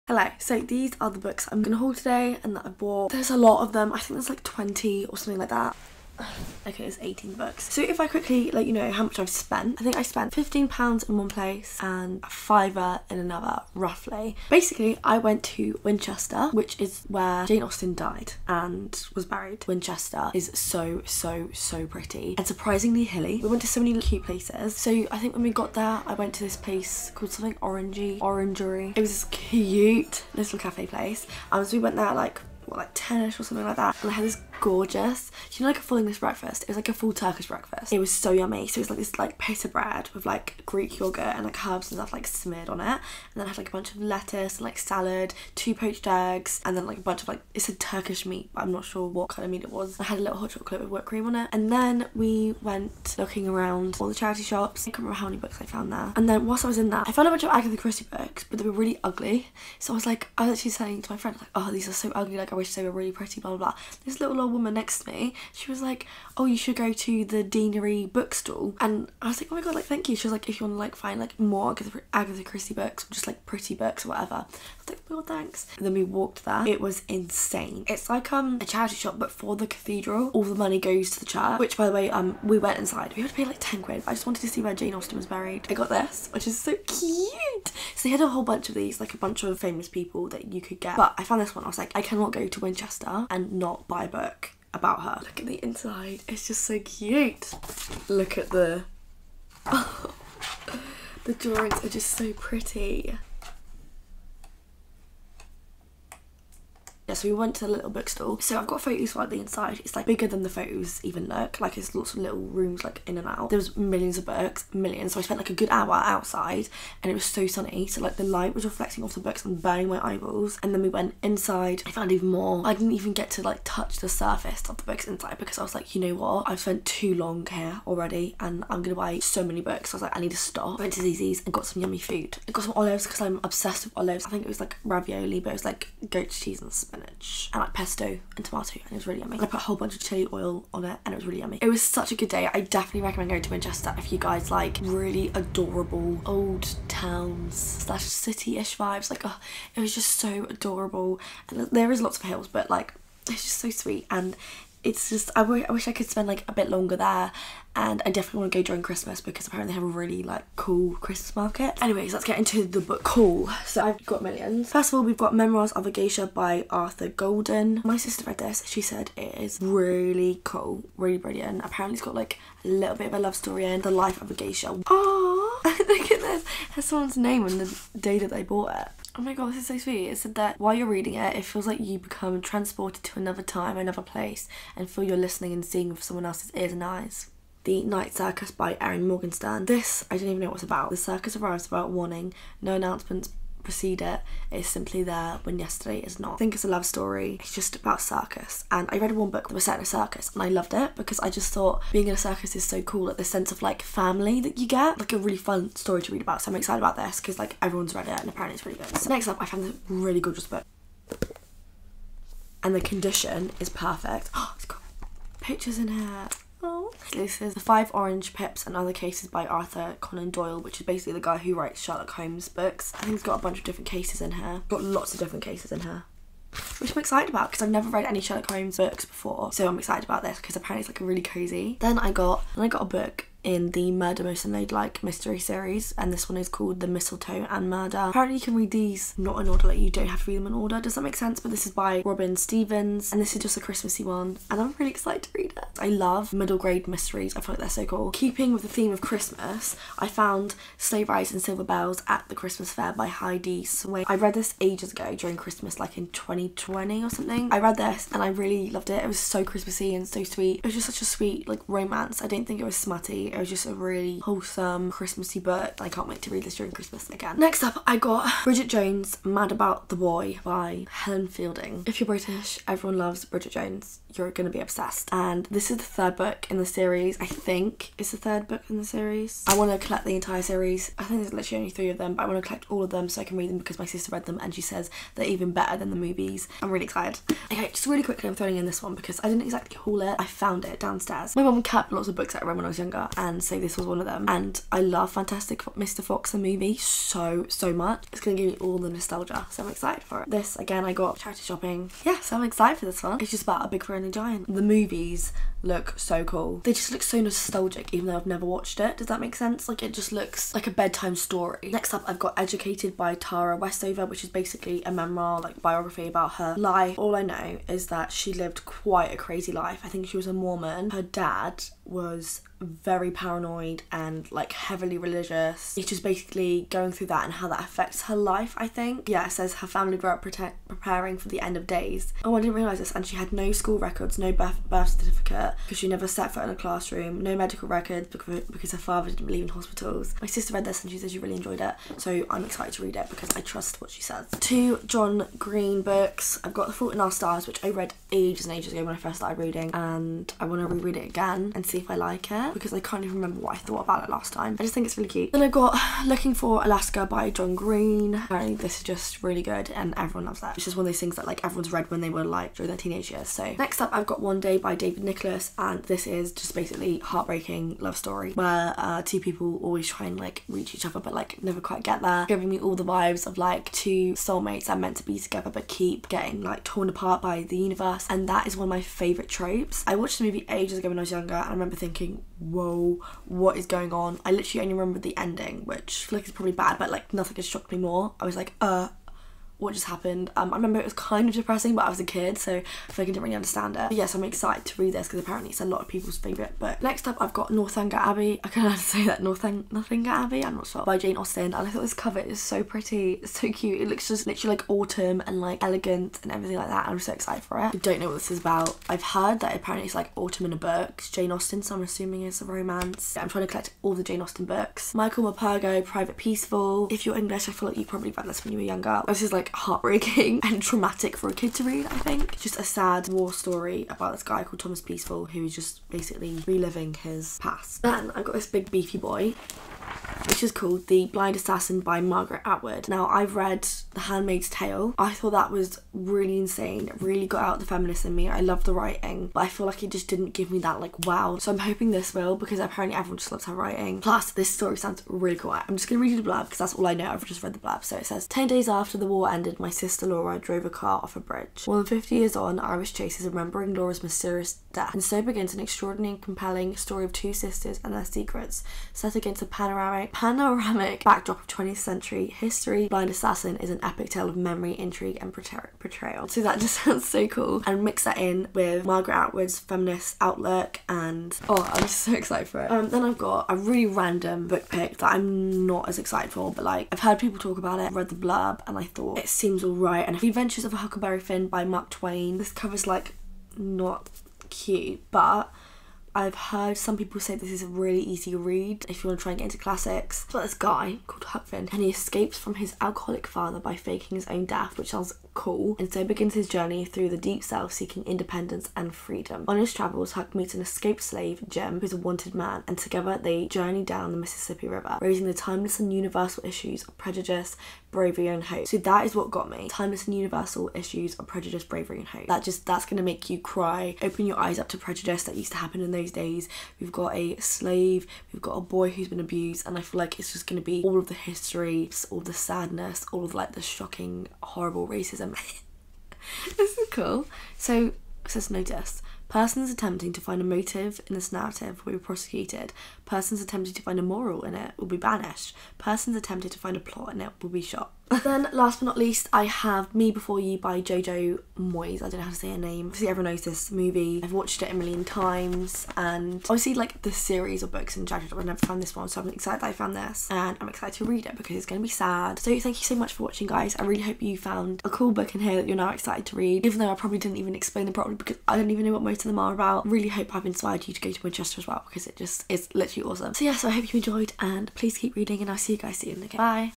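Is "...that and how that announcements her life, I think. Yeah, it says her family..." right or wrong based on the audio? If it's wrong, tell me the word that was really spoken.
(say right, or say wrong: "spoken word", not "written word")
wrong: "affects", not "announcements".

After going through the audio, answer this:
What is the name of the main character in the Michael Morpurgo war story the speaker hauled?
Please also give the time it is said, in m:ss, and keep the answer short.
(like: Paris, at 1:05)
Thomas Peaceful, at 7:04.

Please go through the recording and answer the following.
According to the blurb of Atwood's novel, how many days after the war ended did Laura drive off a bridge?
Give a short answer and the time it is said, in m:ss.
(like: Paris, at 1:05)
10, at 7:28.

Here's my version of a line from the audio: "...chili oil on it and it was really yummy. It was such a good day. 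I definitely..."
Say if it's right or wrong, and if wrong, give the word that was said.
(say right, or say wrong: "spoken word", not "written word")
right.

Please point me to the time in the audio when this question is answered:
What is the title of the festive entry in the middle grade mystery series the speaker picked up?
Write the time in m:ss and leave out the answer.
3:56.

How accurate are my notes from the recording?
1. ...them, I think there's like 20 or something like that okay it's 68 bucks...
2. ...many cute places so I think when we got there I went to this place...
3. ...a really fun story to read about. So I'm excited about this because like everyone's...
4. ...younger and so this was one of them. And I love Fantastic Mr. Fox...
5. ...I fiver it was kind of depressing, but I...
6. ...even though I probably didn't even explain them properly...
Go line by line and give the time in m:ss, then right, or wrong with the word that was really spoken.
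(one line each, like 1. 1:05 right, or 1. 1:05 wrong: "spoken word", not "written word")
1. 0:03 wrong: "18", not "68"
2. 0:23 right
3. 3:25 right
4. 4:52 right
5. 6:30 wrong: "remember", not "fiver"
6. 9:16 right.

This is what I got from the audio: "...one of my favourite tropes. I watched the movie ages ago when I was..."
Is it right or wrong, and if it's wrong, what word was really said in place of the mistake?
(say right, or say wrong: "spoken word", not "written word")
right.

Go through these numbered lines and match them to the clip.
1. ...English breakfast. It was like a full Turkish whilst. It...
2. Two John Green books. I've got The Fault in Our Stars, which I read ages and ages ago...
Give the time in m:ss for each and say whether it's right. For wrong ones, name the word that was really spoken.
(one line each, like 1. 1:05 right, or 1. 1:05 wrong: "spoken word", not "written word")
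1. 0:35 wrong: "breakfast", not "whilst"
2. 5:44 right.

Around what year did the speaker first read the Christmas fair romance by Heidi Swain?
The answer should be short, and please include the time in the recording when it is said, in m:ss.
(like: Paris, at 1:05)
2020, at 4:16.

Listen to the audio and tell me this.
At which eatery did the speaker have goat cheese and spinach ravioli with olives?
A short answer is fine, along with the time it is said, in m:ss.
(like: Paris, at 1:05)
ZZ's, at 2:11.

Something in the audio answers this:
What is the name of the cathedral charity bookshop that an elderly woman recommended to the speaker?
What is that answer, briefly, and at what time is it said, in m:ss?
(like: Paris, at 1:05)
Deanery bookstall, at 1:07.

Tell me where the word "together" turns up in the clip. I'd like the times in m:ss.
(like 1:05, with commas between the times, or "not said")
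6:15, 8:22.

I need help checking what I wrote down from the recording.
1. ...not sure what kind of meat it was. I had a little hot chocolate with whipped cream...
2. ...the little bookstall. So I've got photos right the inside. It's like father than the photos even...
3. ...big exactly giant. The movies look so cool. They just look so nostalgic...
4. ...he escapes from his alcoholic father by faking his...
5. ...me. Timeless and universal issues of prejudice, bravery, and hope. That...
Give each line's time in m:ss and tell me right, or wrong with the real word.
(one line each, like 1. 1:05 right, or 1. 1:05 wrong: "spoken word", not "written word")
1. 0:48 right
2. 1:47 wrong: "bigger", not "father"
3. 5:03 wrong: "friendly", not "exactly"
4. 8:11 right
5. 8:29 right.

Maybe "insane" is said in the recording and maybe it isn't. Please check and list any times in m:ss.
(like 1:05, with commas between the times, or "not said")
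1:17, 7:16.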